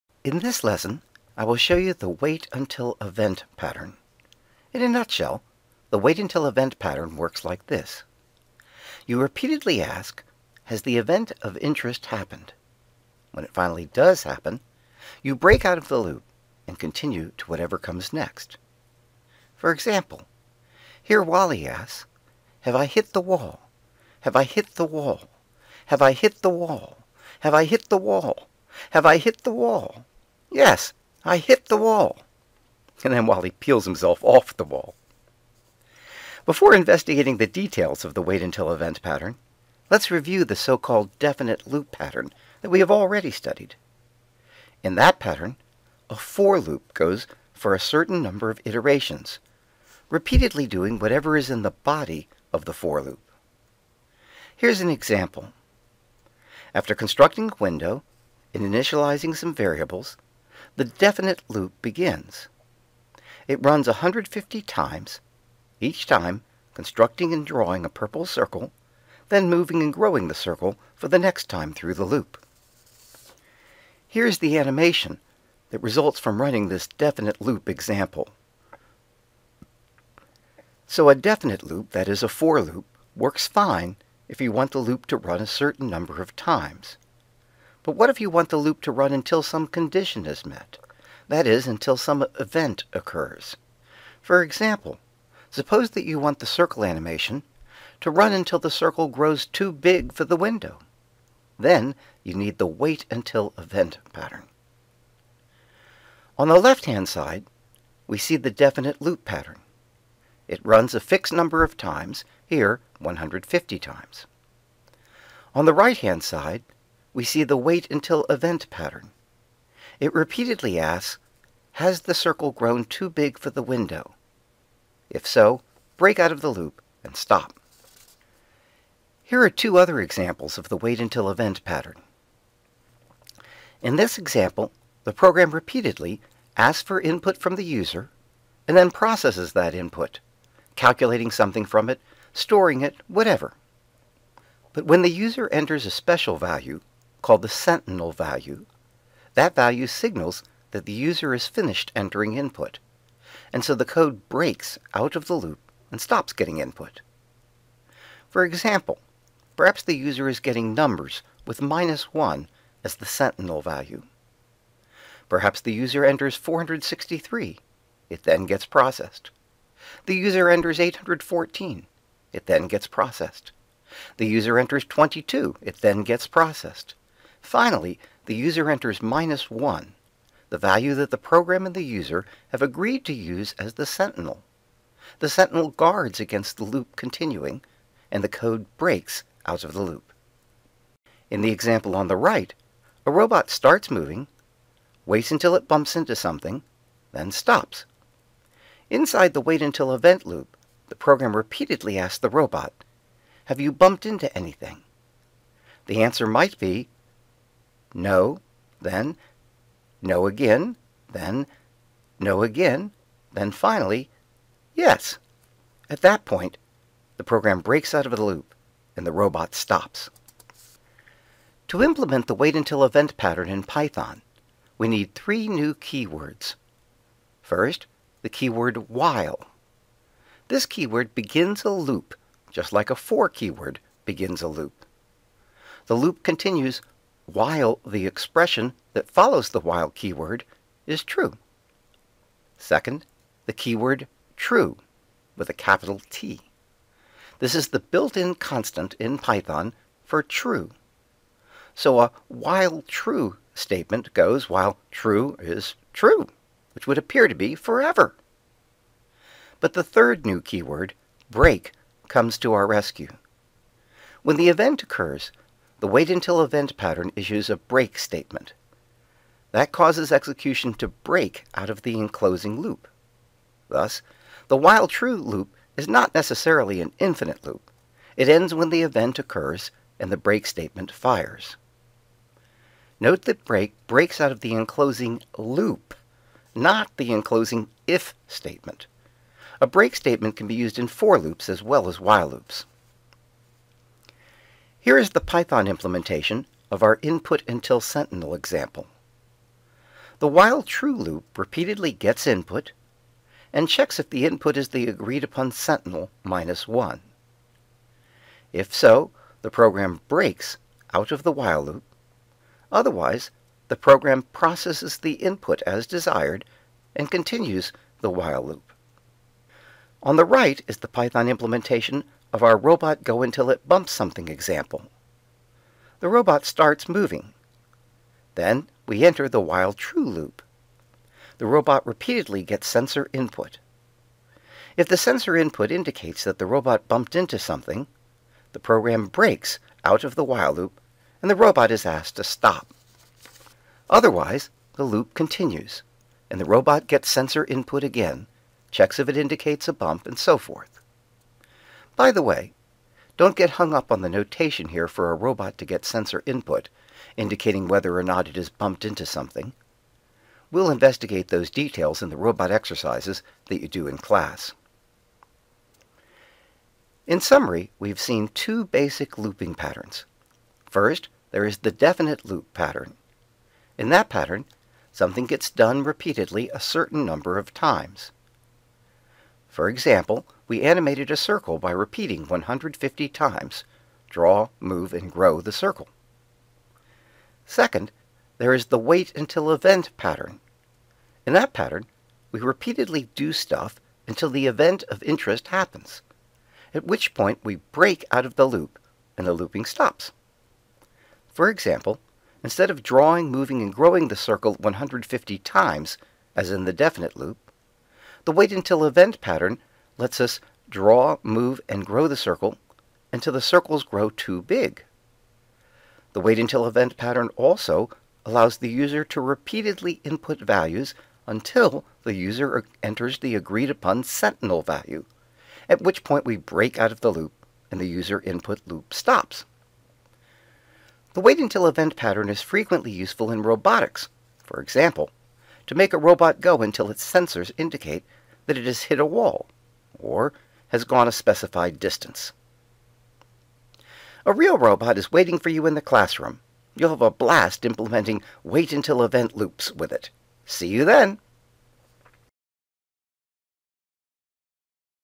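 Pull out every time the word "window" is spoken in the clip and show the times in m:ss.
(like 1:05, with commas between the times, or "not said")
0:57, 1:40, 2:03.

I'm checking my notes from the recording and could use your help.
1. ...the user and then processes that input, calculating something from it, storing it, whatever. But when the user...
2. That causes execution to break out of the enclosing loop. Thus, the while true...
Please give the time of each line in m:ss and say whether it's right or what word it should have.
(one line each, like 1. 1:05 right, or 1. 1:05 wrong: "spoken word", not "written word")
1. 2:17 right
2. 4:29 right.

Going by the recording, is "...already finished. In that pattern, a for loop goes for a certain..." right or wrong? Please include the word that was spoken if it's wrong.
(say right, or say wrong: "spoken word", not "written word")
wrong: "studied", not "finished".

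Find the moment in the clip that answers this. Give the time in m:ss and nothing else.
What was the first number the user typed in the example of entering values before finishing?
2:46.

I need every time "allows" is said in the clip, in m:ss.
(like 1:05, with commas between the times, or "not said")
6:58.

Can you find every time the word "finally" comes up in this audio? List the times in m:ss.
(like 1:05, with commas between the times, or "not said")
0:13, 2:57, 3:33.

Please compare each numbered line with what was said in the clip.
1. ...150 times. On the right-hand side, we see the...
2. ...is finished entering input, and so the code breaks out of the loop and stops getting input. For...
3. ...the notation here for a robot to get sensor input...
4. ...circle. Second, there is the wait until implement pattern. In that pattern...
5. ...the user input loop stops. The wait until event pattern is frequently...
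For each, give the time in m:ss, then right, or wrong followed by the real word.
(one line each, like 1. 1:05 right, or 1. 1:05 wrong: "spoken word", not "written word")
1. 1:52 right
2. 2:31 right
3. 5:54 right
4. 6:25 wrong: "event", not "implement"
5. 7:07 right.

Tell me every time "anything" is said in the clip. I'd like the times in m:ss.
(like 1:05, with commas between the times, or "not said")
3:24.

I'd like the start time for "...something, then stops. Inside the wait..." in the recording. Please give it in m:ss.
3:16.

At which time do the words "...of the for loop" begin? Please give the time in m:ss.
0:52.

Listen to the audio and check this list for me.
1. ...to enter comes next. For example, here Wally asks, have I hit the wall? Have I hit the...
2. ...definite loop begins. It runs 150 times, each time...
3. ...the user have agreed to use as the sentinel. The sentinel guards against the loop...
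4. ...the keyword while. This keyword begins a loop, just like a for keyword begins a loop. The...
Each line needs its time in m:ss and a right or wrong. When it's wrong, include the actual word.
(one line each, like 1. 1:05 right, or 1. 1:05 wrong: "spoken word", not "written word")
1. 0:17 wrong: "whatever", not "enter"
2. 1:00 right
3. 3:01 right
4. 3:48 right.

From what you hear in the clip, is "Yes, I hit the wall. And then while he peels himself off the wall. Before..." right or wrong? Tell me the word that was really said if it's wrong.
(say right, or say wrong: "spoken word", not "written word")
right.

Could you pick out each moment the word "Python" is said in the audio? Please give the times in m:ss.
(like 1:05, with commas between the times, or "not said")
3:43, 4:09, 4:55, 5:20.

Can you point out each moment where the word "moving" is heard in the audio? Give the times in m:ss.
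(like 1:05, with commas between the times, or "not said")
1:09, 3:13, 5:26, 6:43.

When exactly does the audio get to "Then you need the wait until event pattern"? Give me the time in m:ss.
1:41.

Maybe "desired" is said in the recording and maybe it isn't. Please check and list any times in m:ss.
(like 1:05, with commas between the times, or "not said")
5:15.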